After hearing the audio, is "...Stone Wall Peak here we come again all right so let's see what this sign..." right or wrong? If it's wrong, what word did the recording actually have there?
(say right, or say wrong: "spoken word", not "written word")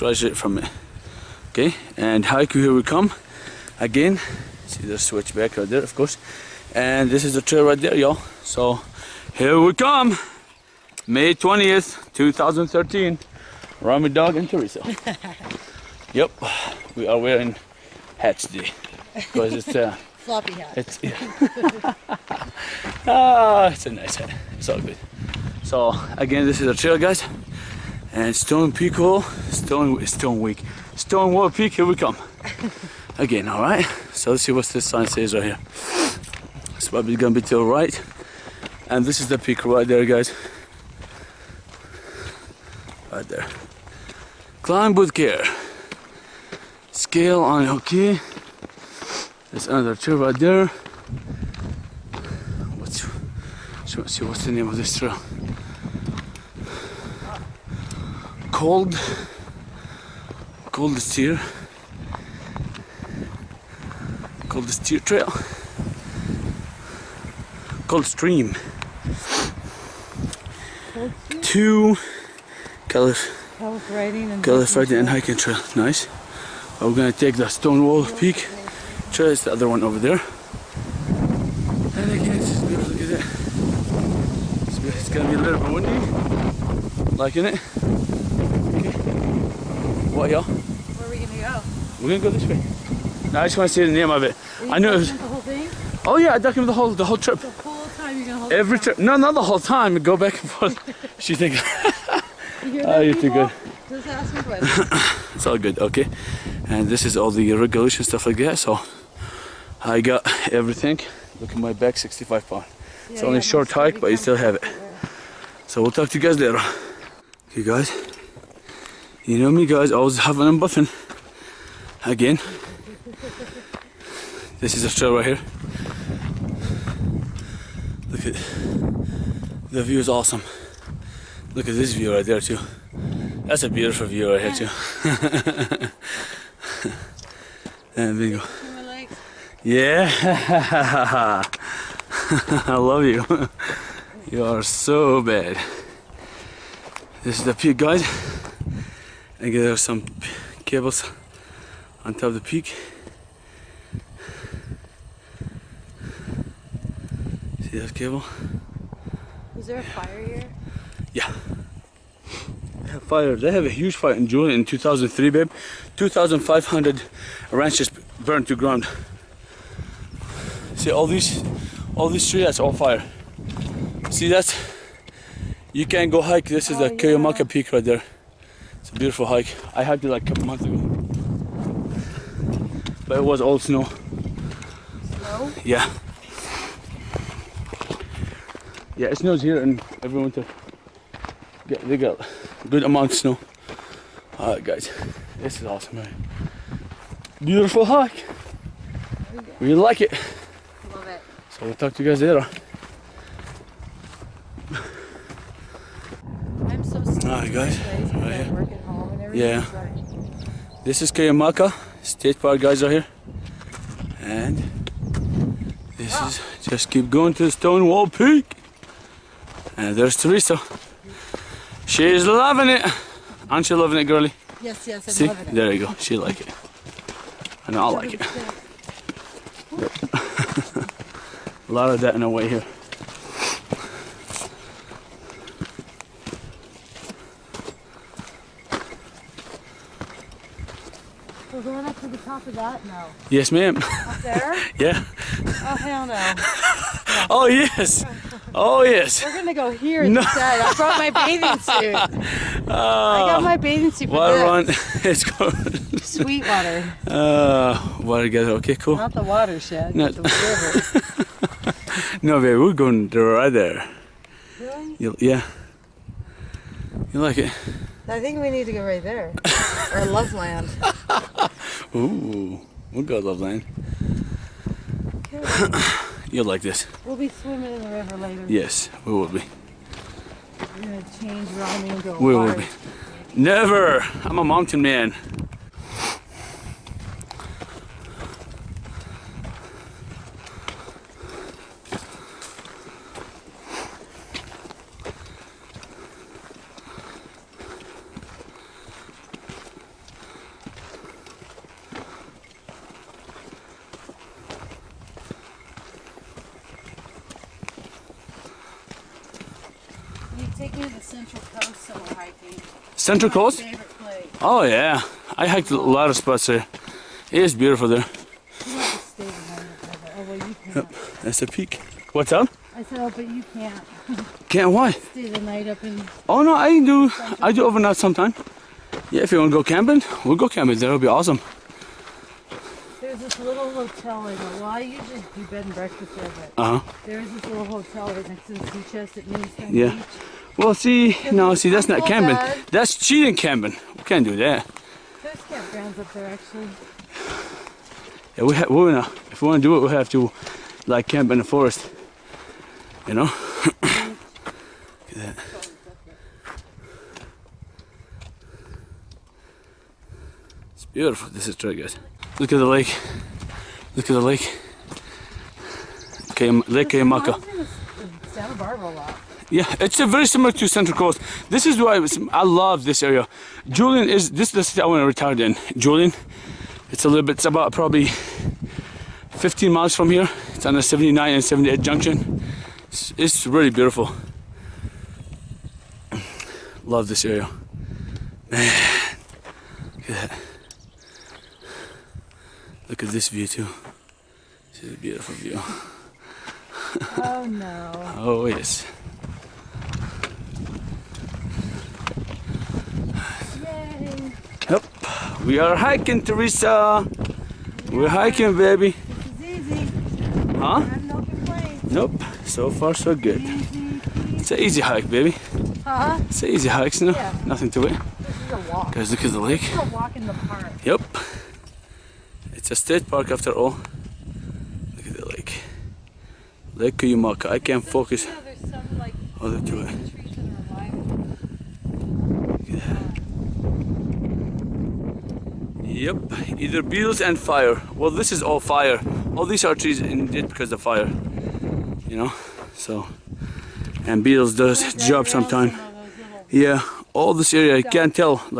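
right.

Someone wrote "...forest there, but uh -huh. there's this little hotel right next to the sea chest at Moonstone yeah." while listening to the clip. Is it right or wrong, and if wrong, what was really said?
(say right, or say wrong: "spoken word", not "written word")
wrong: "breakfast", not "forest".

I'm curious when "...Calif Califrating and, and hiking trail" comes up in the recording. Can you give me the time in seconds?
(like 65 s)
72 s.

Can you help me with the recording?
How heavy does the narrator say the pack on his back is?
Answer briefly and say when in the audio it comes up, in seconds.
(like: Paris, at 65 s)
65 pounds, at 111 s.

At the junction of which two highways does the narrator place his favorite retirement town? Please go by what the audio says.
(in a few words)
79 and 78.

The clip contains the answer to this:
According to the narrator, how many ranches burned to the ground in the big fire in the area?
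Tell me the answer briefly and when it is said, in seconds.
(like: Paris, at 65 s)
2,500, at 165 s.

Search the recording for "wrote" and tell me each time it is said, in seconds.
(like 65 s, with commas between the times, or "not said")
not said.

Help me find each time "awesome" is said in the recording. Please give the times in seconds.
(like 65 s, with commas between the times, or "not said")
130 s, 195 s, 331 s.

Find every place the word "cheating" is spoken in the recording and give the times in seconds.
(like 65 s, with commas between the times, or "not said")
342 s.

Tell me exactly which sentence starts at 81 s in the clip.
And again, it's Look at that.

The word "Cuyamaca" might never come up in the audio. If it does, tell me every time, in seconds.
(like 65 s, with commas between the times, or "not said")
211 s, 426 s.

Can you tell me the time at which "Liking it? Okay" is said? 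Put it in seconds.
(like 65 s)
87 s.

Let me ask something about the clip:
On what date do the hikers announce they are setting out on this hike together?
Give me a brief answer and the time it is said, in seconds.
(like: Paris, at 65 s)
May 20th 2013, at 11 s.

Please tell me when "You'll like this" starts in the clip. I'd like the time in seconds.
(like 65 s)
276 s.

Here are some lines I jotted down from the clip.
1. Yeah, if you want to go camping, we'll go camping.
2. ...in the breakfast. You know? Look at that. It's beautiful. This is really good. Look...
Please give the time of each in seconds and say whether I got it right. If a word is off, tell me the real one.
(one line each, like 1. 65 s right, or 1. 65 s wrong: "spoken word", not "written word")
1. 329 s right
2. 351 s wrong: "forest", not "breakfast".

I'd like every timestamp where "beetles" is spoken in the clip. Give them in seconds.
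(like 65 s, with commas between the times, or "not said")
436 s, 444 s.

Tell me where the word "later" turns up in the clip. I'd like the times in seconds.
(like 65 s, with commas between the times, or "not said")
116 s, 202 s, 278 s.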